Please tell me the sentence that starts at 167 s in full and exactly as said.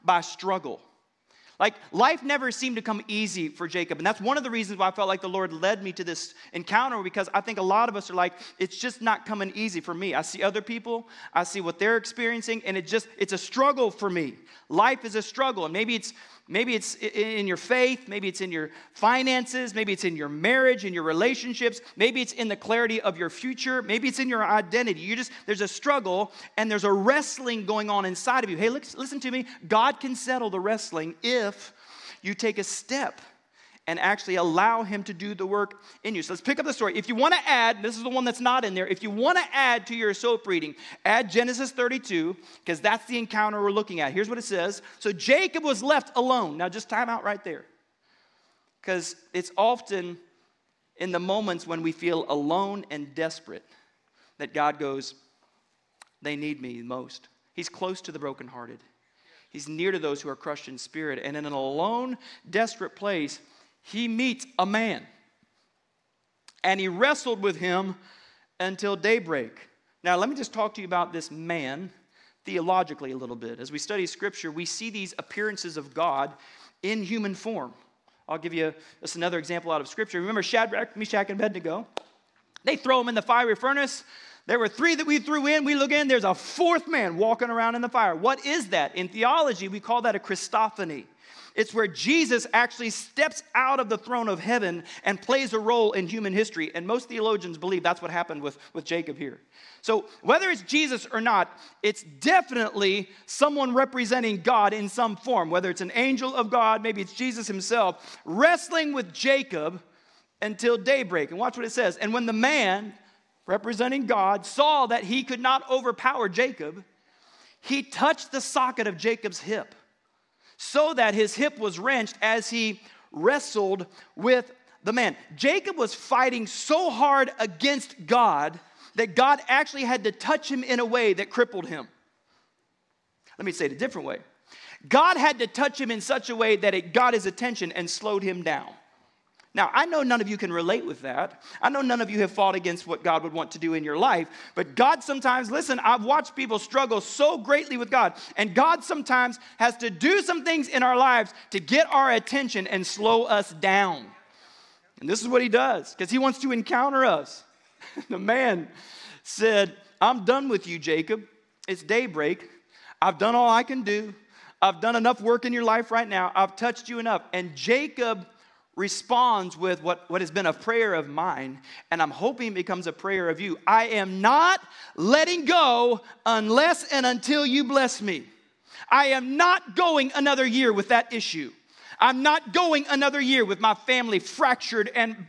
And Jacob responds with what, what has been a prayer of mine, and I'm hoping becomes a prayer of you.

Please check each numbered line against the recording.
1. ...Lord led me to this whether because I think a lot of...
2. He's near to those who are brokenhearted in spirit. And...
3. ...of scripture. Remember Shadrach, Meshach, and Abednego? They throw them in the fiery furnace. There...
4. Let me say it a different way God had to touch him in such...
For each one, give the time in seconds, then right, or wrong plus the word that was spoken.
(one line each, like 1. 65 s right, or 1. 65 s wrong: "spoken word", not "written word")
1. 5 s wrong: "encounter", not "whether"
2. 59 s wrong: "crushed", not "brokenhearted"
3. 79 s right
4. 133 s right.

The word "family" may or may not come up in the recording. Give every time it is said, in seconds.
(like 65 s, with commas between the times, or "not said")
183 s.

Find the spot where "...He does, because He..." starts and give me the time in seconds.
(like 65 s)
155 s.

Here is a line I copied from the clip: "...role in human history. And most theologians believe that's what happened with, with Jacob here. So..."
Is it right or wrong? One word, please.
right.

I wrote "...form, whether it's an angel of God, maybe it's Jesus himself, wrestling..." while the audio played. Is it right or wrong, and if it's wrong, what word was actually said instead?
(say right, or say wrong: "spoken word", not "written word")
right.